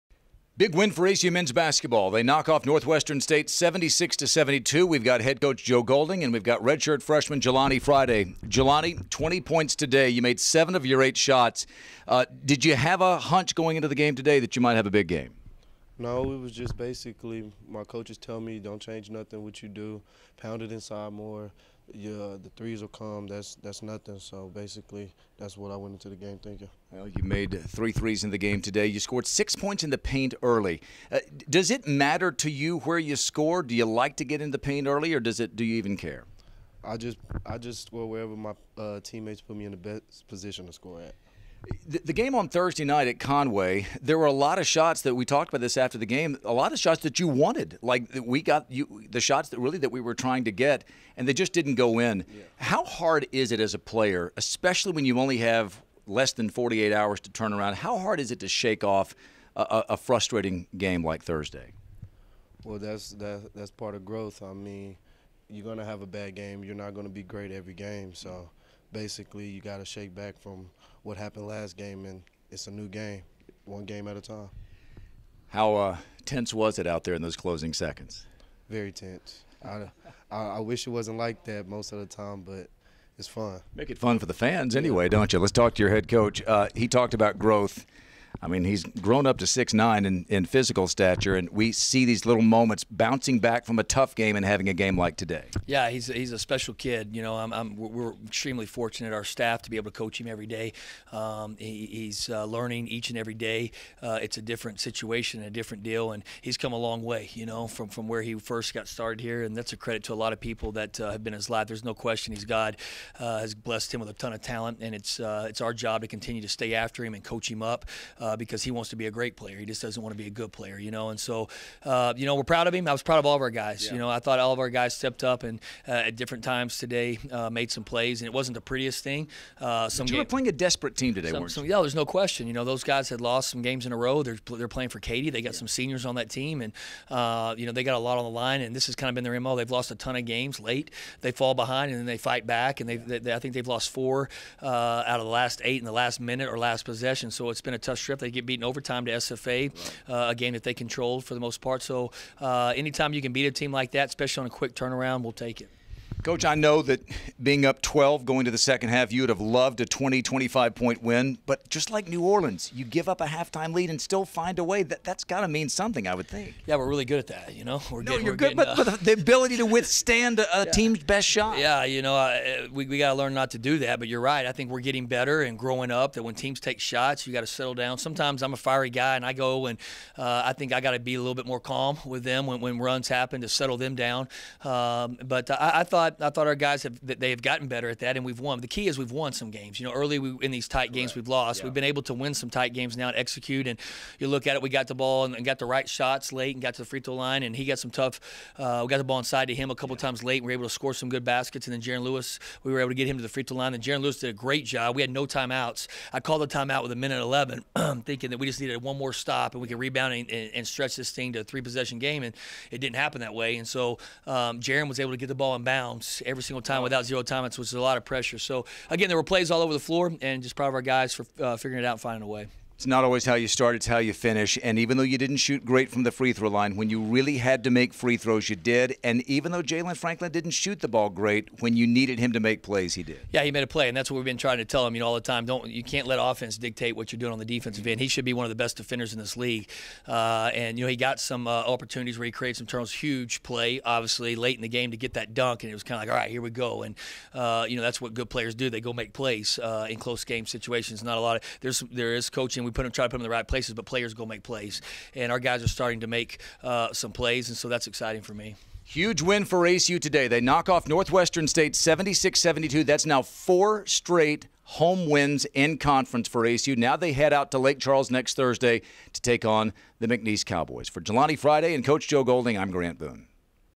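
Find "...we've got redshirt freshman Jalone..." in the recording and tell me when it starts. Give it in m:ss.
0:06.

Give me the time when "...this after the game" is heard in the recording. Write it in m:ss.
0:45.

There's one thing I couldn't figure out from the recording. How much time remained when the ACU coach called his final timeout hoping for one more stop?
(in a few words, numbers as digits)
1:11.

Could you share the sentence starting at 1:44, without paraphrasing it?
Uh, it's a different situation, a different deal, and he's come a long way.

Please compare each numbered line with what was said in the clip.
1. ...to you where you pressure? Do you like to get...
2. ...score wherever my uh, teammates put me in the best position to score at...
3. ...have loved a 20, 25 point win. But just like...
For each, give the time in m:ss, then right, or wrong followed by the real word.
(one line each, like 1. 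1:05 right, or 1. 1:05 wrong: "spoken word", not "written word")
1. 0:32 wrong: "score", not "pressure"
2. 0:37 right
3. 2:39 right.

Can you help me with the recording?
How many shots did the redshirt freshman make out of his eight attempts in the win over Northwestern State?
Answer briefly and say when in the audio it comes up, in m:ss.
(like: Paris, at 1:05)
7, at 0:10.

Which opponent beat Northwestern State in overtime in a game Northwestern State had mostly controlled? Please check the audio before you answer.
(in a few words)
SFA.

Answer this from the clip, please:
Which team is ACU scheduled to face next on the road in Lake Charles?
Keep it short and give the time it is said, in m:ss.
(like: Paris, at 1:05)
McNeese Cowboys, at 4:30.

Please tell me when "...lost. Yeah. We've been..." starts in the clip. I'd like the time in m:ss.
3:11.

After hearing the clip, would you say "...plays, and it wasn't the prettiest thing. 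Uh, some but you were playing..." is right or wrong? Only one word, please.
right.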